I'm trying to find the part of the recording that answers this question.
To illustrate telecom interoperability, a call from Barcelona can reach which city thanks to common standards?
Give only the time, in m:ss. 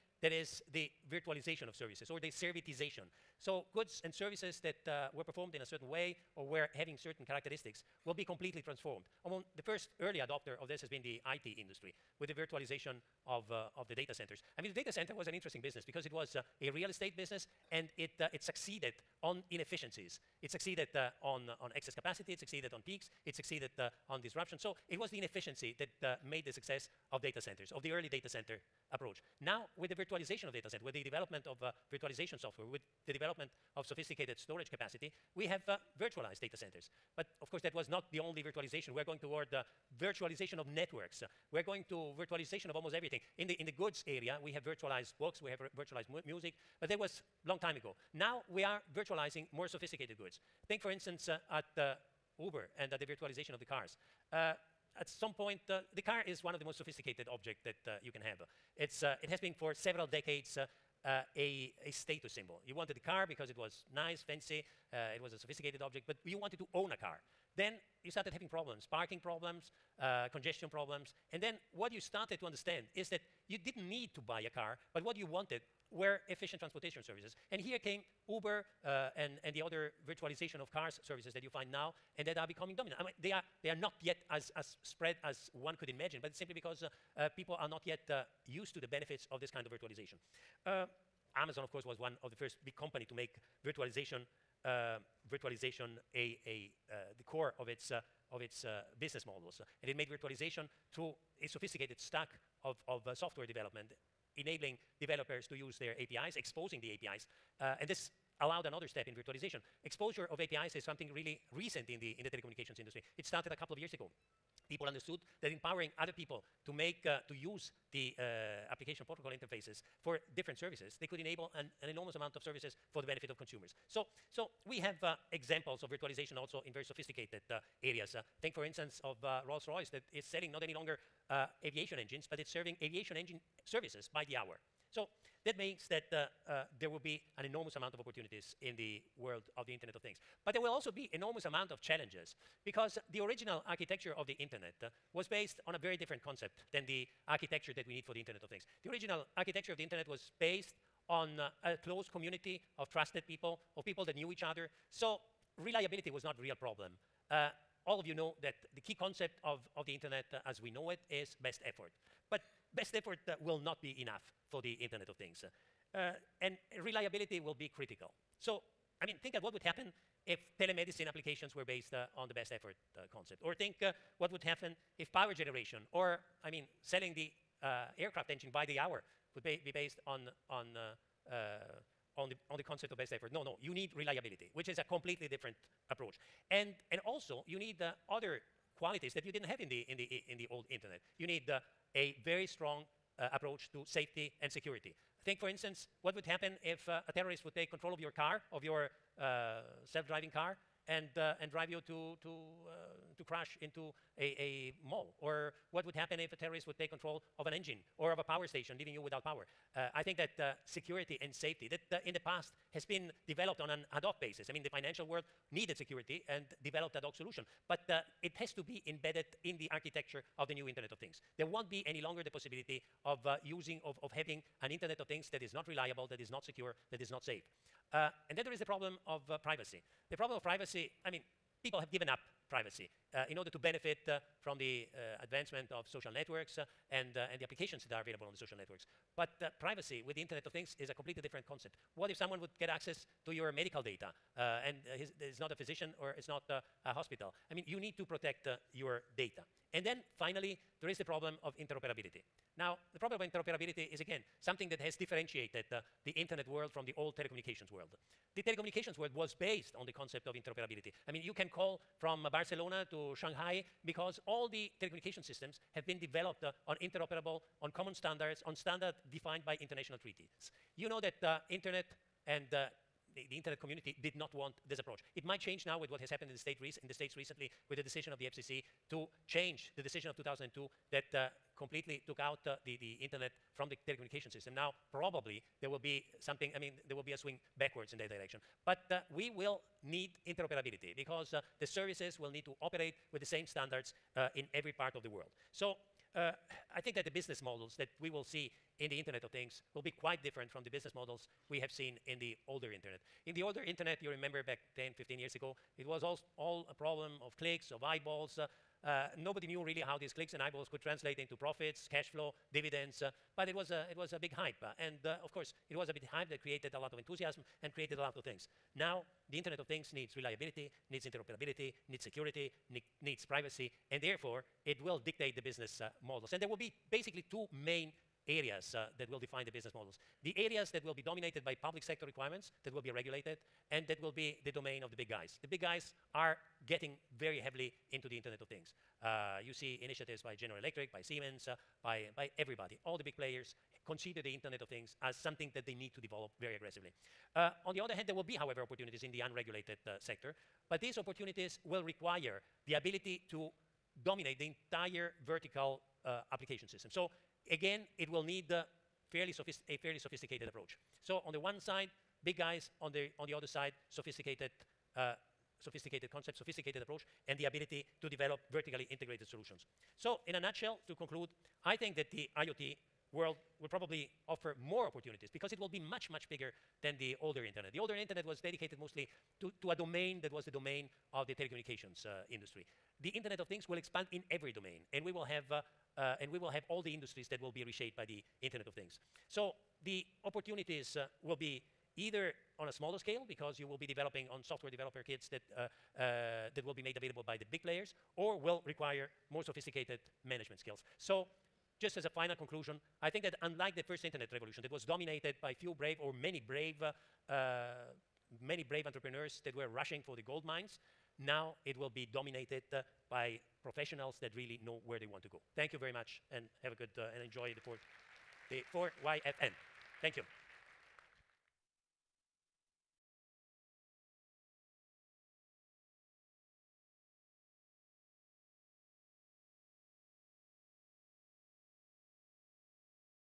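4:23.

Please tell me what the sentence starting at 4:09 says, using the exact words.
And then finally, there is the problem of interoperability.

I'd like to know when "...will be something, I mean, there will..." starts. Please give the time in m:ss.
4:45.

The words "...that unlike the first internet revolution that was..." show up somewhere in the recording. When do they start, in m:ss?
6:43.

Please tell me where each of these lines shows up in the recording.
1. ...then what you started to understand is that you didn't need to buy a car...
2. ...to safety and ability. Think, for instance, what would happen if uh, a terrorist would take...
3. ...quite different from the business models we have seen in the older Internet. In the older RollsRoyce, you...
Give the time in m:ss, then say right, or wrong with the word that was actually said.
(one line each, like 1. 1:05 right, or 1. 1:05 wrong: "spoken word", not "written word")
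1. 1:11 right
2. 3:13 wrong: "security", not "ability"
3. 5:00 wrong: "Internet", not "RollsRoyce".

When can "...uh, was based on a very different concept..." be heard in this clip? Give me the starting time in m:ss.
2:24.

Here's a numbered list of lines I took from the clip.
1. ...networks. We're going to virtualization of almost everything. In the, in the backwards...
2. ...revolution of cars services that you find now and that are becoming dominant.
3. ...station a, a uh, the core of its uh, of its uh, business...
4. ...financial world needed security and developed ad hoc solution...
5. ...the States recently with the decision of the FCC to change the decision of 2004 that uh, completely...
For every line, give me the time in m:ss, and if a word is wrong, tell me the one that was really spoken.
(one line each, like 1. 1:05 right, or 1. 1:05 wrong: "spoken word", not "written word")
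1. 0:40 wrong: "goods", not "backwards"
2. 1:20 wrong: "virtualization", not "revolution"
3. 1:35 wrong: "virtualization", not "station"
4. 3:34 right
5. 4:36 wrong: "2002", not "2004".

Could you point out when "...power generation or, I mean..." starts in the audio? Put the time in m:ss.
2:55.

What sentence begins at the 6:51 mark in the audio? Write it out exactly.
Now it will be dominated uh, by professionals that really know where they want to go.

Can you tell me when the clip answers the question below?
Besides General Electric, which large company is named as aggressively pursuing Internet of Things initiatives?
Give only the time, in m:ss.
5:41.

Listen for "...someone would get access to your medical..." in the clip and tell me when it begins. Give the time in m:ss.
4:02.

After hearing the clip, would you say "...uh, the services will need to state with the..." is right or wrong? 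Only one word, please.
wrong.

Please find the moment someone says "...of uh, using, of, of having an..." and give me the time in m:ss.
3:43.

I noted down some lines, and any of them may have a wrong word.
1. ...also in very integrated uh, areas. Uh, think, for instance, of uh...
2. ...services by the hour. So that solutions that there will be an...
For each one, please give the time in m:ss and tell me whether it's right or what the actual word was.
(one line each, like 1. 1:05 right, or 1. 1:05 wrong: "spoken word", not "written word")
1. 2:06 wrong: "sophisticated", not "integrated"
2. 2:13 wrong: "means", not "solutions".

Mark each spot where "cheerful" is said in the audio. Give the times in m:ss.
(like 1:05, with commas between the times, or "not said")
not said.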